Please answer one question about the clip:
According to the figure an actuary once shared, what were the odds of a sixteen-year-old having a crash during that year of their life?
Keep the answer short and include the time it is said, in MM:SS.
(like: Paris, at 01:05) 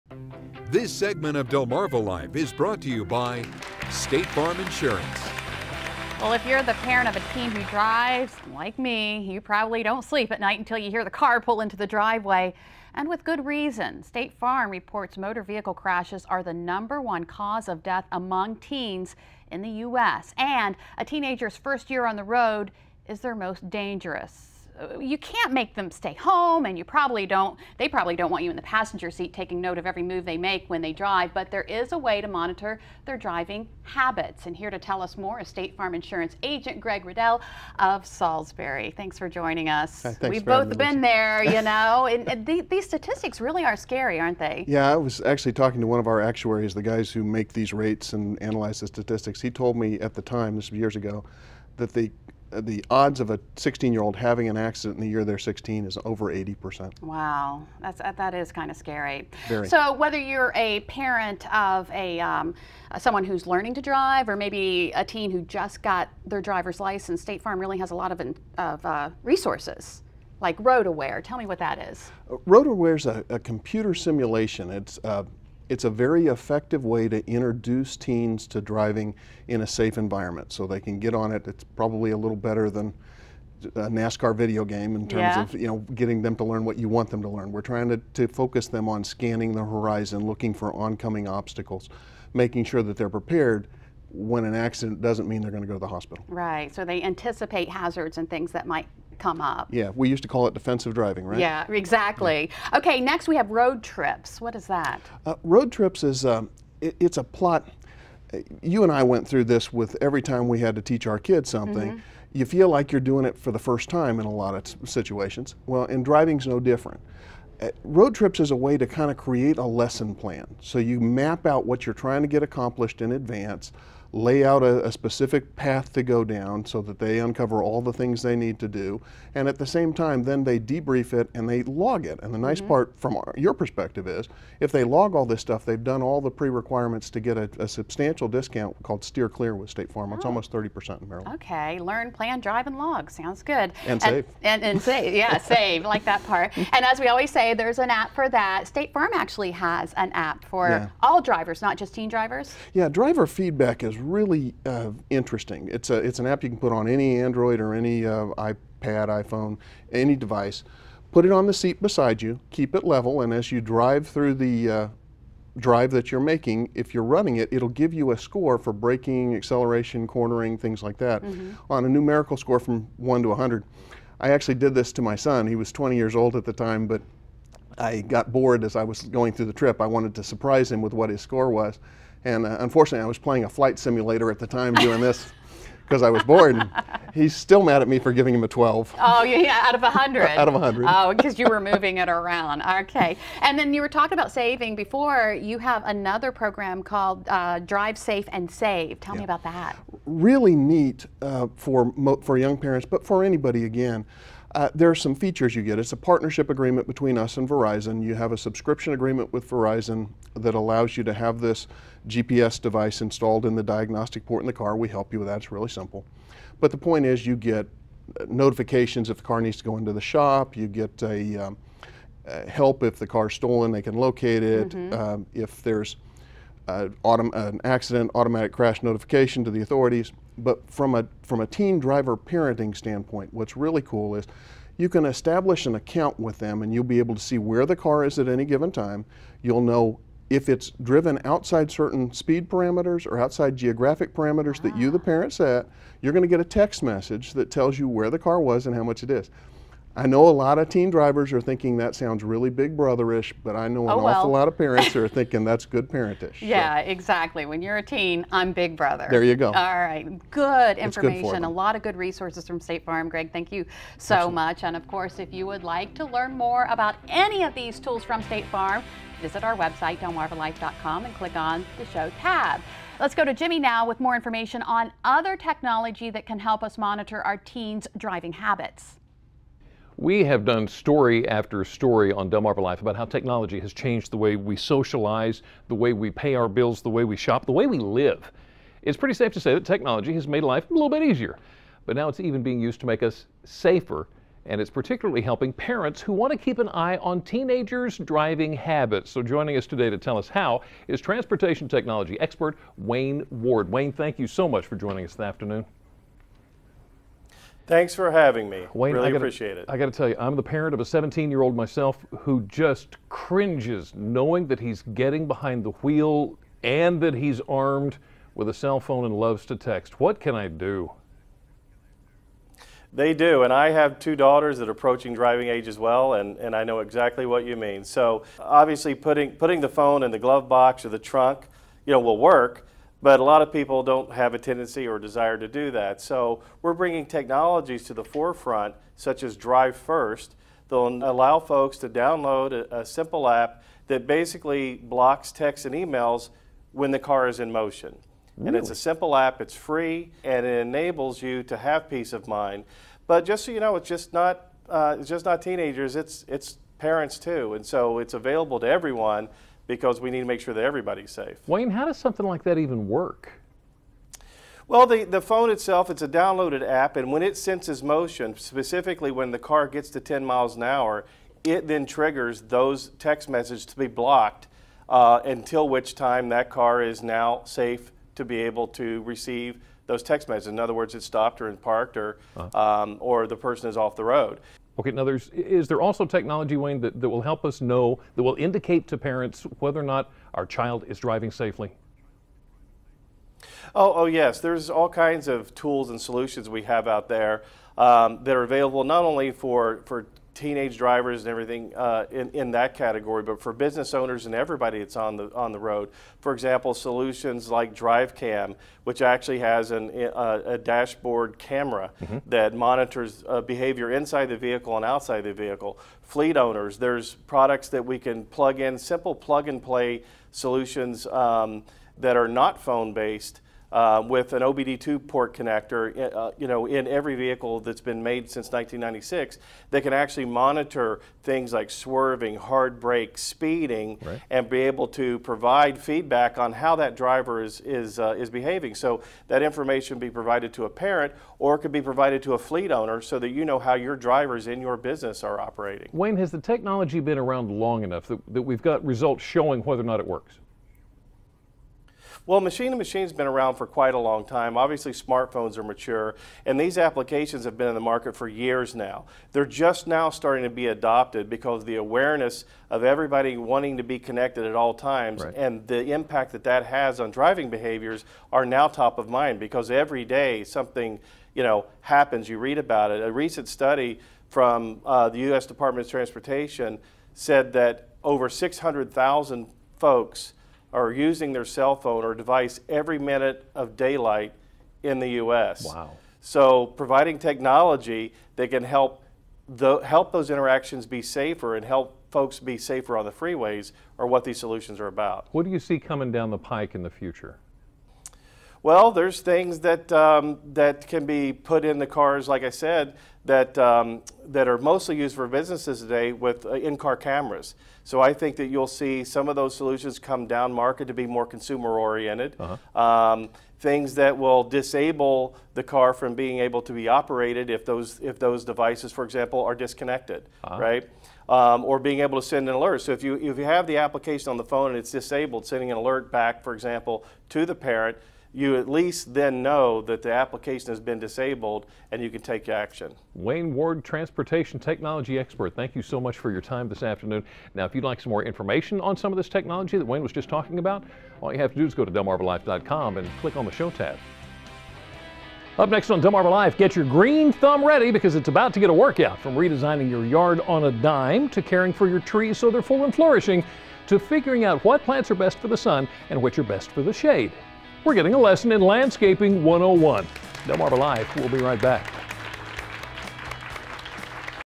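over 80%, at 00:56.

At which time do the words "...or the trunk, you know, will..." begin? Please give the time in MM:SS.
05:30.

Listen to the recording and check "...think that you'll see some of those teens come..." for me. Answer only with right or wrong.
wrong.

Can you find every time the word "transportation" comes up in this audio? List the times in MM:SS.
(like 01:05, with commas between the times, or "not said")
05:00, 07:55, 08:53.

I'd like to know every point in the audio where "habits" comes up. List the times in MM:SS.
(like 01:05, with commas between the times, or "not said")
00:33, 04:38, 04:58.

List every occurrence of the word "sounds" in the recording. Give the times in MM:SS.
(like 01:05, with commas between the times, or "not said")
02:23, 04:11.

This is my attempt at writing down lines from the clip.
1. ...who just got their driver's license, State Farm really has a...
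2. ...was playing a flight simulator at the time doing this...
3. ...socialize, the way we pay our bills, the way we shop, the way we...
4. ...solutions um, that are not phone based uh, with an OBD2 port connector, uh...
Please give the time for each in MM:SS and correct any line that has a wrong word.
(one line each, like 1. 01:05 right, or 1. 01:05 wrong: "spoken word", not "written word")
1. 01:05 right
2. 03:03 right
3. 04:44 right
4. 07:00 right.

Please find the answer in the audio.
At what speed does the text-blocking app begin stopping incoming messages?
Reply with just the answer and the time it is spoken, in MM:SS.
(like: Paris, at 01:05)
10 miles an hour, at 06:09.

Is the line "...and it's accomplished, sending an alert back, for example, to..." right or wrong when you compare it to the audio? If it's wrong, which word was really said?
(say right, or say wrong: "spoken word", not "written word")
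wrong: "disabled", not "accomplished".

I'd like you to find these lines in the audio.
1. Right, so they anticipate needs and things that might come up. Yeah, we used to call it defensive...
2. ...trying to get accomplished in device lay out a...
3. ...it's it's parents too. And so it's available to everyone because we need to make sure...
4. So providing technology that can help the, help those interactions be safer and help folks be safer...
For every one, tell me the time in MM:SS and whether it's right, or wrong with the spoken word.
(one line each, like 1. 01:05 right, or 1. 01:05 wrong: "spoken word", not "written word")
1. 01:36 wrong: "hazards", not "needs"
2. 02:02 wrong: "advance", not "device"
3. 05:55 right
4. 08:06 right.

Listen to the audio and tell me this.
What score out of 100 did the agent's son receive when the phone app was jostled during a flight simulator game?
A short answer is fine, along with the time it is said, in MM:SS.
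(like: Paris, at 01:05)
12, at 03:08.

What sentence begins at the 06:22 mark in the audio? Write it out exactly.
um, or the person is off the road.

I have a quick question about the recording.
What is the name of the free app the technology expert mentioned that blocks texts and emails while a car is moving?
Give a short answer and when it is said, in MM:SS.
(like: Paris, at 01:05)
Drive First, at 05:39.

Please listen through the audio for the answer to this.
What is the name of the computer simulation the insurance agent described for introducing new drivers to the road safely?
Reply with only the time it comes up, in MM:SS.
01:12.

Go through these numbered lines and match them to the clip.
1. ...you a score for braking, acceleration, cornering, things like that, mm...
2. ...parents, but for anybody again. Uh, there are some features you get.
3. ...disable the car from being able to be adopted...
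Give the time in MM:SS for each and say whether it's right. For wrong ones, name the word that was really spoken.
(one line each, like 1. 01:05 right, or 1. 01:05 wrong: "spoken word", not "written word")
1. 02:47 right
2. 03:22 right
3. 08:34 wrong: "operated", not "adopted".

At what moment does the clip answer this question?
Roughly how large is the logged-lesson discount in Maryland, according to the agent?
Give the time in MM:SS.
02:20.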